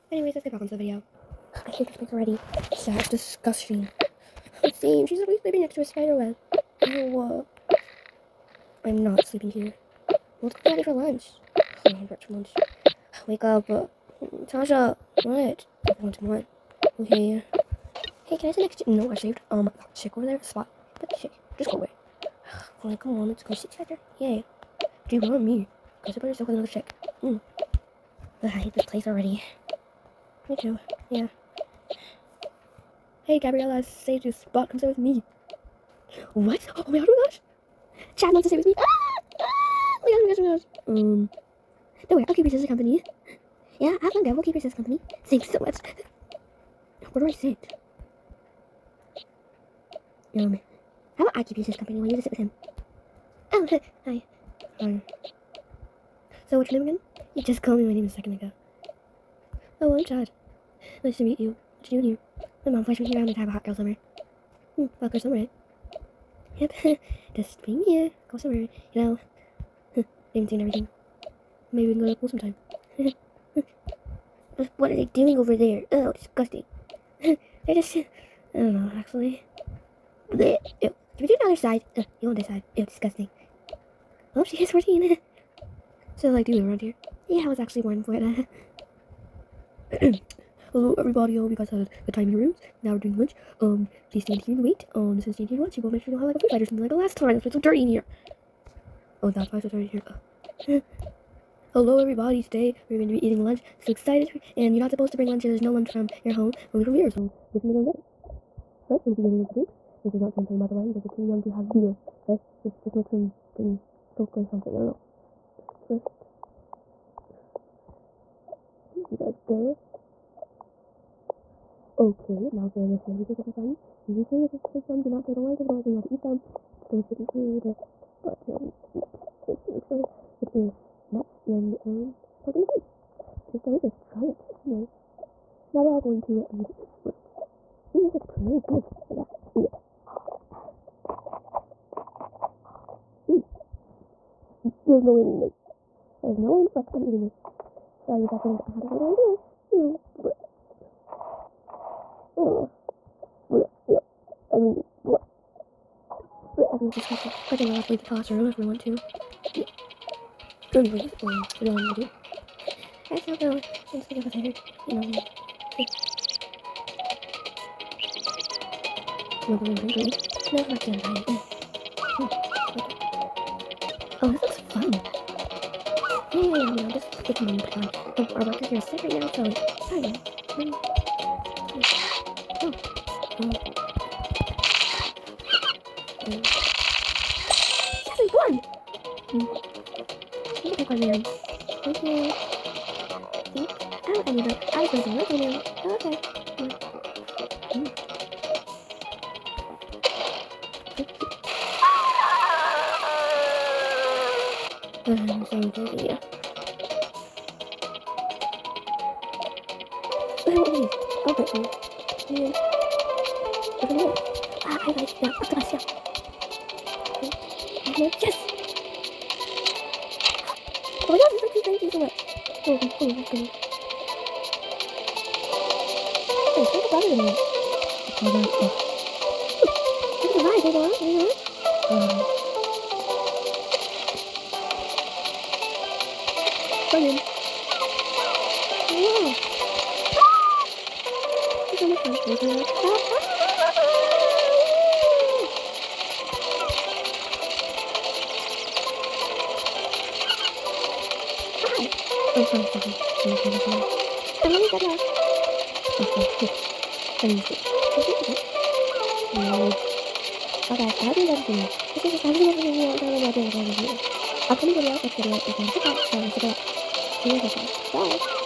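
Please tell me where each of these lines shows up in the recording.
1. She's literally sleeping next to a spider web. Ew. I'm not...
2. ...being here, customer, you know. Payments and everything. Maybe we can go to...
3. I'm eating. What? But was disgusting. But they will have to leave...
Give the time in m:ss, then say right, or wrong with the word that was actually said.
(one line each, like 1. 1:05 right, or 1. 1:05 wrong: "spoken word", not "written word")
1. 0:05 right
2. 1:07 right
3. 2:34 wrong: "leaving", not "eating".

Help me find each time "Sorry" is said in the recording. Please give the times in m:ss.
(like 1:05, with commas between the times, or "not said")
2:27.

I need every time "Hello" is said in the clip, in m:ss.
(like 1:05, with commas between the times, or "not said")
1:30, 1:41.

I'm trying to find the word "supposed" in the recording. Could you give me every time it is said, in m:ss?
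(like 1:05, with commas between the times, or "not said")
1:44.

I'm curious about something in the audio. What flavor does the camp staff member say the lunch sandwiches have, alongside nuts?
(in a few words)
pumpkin spice.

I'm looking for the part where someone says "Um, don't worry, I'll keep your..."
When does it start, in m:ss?
0:41.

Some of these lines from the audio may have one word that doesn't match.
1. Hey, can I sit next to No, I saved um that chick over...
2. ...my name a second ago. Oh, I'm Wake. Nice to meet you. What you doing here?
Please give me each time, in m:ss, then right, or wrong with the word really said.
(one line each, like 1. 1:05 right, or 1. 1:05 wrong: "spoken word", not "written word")
1. 0:18 right
2. 0:57 wrong: "Chad", not "Wake".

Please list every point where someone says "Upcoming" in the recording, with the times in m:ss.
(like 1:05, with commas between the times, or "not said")
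4:24.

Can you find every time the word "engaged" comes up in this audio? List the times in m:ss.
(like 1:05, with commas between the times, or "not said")
not said.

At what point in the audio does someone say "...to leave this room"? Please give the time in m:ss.
2:16.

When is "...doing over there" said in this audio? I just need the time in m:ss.
1:15.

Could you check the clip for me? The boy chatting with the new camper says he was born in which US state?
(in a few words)
Florida.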